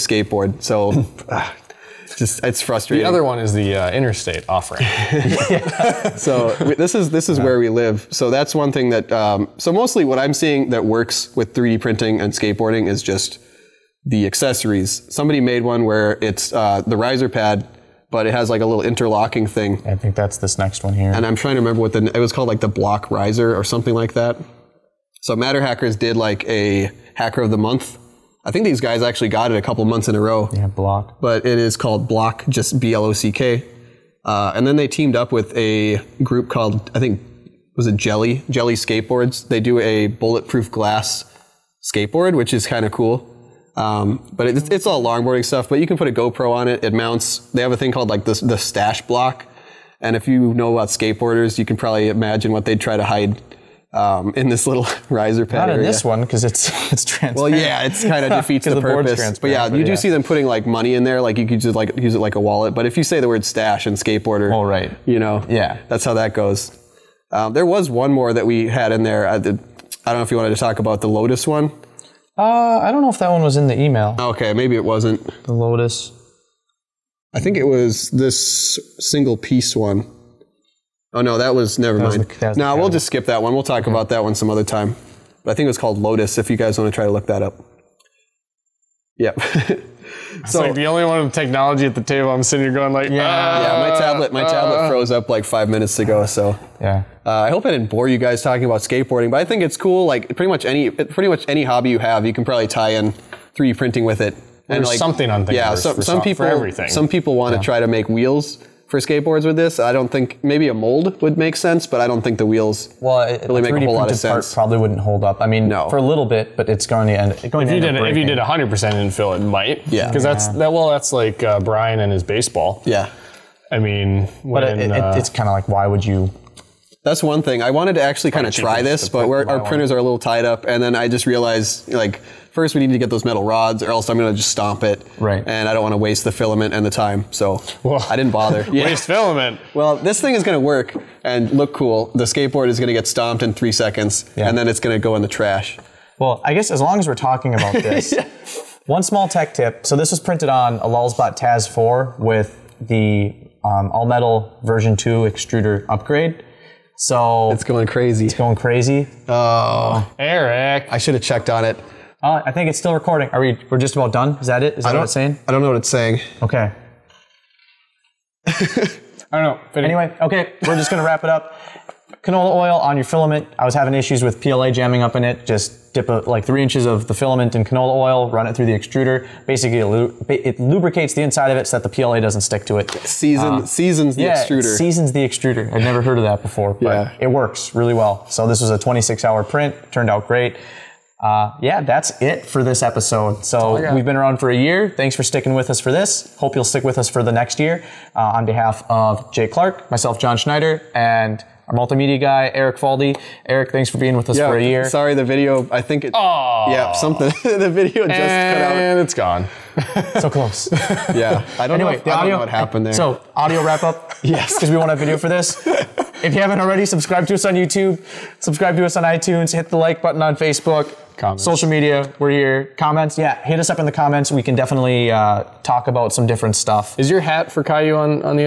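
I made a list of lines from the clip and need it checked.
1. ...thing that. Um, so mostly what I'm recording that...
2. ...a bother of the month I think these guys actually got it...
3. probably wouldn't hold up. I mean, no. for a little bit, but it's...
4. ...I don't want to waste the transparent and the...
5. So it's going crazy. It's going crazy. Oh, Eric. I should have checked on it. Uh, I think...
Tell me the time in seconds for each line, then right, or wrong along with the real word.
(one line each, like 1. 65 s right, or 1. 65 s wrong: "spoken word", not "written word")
1. 8 s wrong: "seeing", not "recording"
2. 26 s wrong: "hacker", not "bother"
3. 114 s right
4. 135 s wrong: "filament", not "transparent"
5. 156 s right.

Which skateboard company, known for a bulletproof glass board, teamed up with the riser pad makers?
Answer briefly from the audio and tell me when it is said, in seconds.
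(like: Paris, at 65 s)
Jelly Skateboards, at 38 s.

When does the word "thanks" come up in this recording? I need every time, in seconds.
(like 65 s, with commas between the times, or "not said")
194 s, 203 s.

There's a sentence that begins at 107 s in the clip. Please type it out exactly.
try to make wheels for skateboards with this.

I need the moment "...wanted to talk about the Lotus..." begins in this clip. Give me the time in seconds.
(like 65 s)
70 s.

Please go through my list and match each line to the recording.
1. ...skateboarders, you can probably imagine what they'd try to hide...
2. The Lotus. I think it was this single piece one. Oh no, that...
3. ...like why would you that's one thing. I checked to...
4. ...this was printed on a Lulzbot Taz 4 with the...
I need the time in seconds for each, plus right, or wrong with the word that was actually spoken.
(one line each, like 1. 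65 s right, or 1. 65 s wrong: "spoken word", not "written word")
1. 50 s right
2. 75 s right
3. 125 s wrong: "wanted", not "checked"
4. 149 s right.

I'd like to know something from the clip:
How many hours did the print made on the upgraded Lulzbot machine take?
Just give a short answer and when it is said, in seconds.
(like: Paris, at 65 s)
26 hours, at 188 s.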